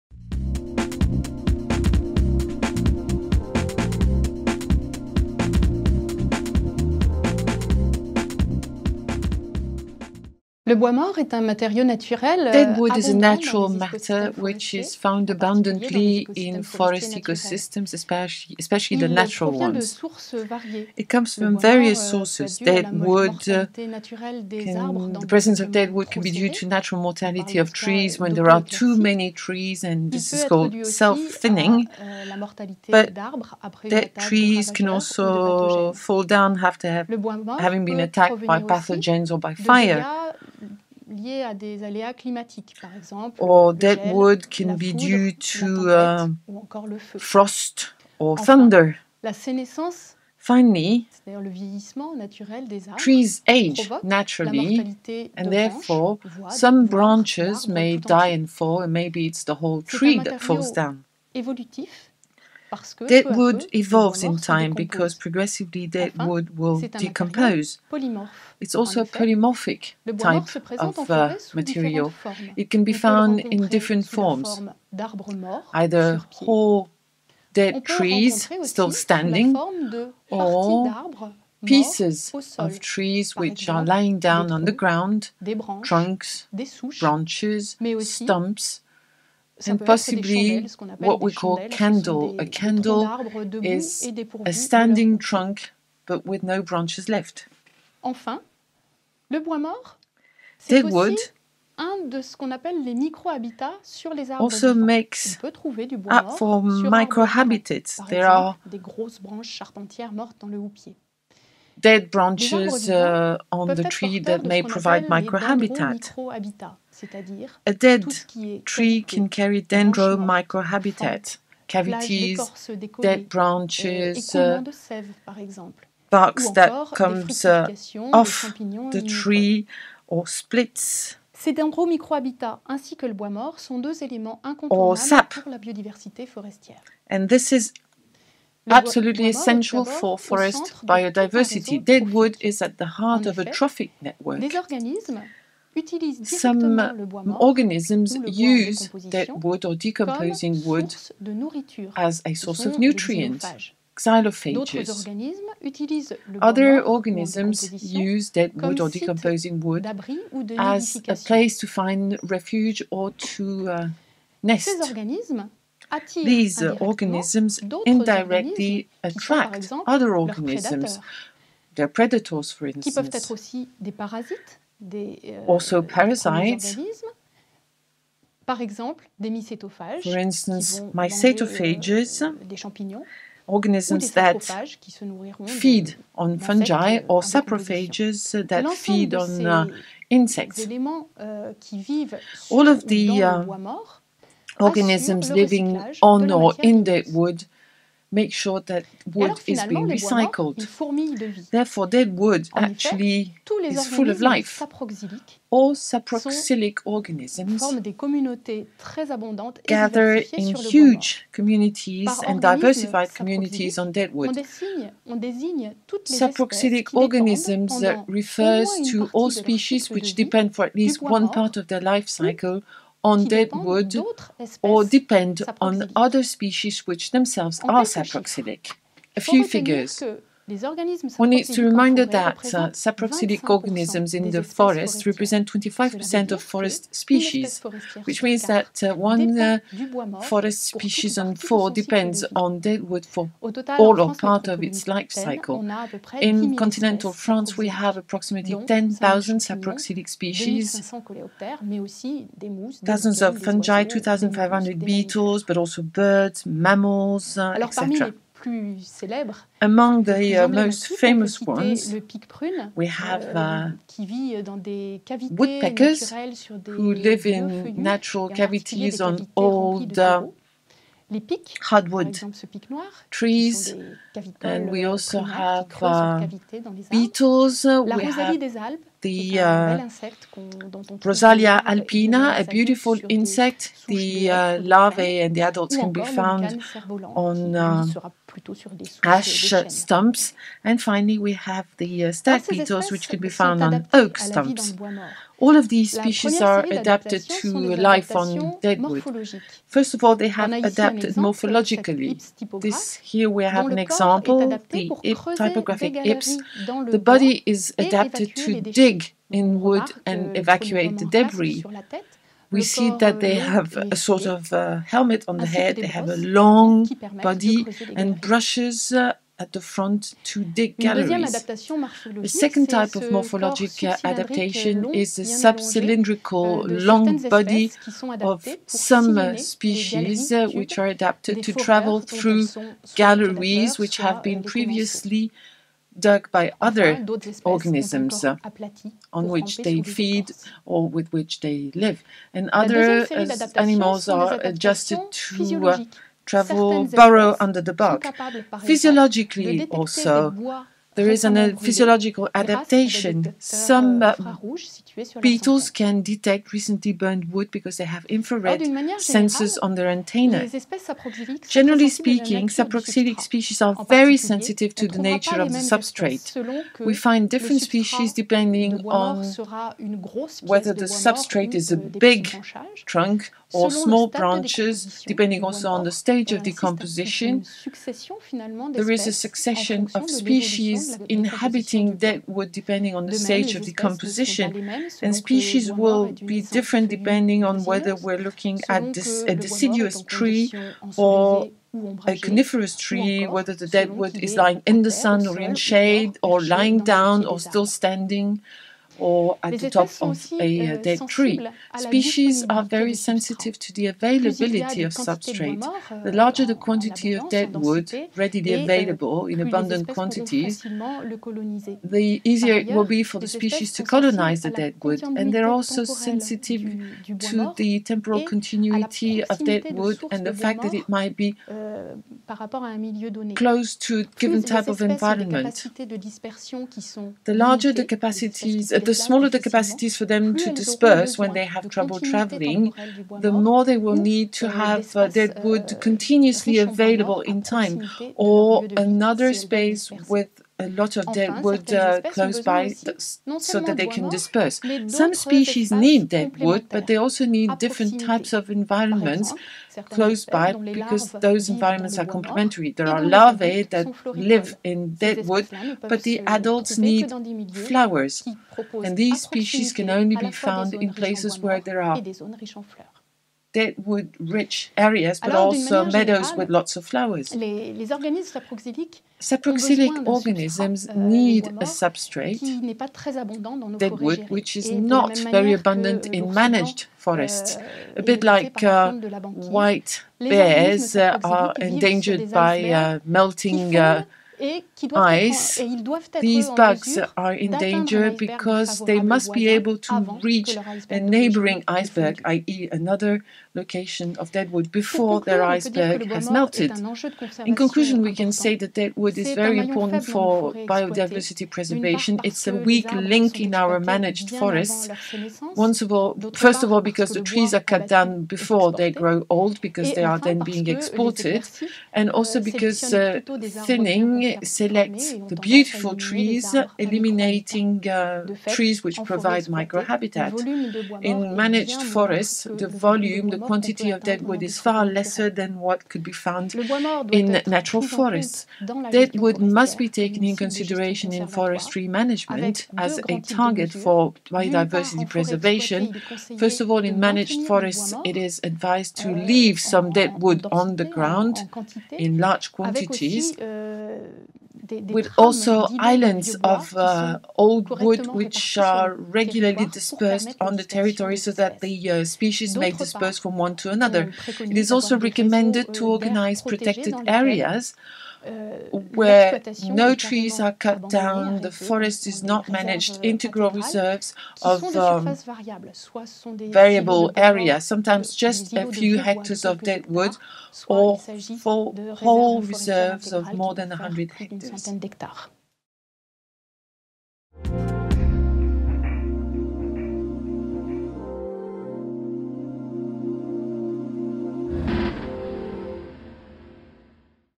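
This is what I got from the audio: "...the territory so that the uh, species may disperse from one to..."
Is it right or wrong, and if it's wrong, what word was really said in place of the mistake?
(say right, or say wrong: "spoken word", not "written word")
right.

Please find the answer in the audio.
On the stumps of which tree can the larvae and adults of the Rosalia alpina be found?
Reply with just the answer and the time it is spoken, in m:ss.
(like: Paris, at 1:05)
ash, at 4:49.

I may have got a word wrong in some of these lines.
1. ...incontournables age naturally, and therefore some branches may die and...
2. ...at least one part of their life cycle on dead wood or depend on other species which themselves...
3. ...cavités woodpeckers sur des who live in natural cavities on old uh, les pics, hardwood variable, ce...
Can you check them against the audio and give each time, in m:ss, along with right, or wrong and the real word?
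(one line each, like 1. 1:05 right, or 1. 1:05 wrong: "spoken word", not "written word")
1. 0:52 wrong: "trees", not "incontournables"
2. 3:40 right
3. 4:25 wrong: "exemple", not "variable".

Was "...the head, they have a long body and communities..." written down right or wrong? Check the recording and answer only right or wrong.
wrong.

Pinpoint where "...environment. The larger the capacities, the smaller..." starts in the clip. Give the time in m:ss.
7:04.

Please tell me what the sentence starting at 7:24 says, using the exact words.
Some species need dead wood, but they also need different types of environments close by because those environments are complementary.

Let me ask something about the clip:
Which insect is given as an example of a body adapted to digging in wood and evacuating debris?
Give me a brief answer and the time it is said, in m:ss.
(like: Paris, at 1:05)
typographic ips, at 5:05.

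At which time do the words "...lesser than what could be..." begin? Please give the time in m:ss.
8:44.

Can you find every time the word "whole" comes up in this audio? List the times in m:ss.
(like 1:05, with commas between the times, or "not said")
0:59, 1:16, 9:31.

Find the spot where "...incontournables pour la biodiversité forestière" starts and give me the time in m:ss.
2:14.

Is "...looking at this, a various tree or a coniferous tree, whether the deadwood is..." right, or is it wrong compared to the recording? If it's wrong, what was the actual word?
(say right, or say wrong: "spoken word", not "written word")
wrong: "deciduous", not "various".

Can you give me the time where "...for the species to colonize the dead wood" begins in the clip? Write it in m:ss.
6:53.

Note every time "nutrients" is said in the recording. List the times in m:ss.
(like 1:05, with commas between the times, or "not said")
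2:32.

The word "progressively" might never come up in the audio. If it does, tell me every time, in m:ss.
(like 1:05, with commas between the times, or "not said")
1:05.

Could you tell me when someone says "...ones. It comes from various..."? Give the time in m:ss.
0:19.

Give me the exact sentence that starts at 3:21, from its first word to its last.
Therefore, dead wood en actually effet, is full of life.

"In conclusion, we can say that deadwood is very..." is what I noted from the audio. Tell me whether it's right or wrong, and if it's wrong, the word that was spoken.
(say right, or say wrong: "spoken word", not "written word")
right.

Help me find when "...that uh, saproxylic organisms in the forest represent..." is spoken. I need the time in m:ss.
3:51.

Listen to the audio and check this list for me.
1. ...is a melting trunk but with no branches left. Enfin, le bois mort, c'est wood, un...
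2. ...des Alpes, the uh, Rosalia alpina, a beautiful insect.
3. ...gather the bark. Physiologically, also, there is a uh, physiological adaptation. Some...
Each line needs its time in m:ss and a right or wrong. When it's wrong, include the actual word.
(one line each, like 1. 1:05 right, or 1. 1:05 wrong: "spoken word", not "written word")
1. 1:33 wrong: "standing", not "melting"
2. 4:38 right
3. 5:47 wrong: "under", not "gather".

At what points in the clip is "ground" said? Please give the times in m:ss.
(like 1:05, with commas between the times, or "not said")
1:24, 9:00.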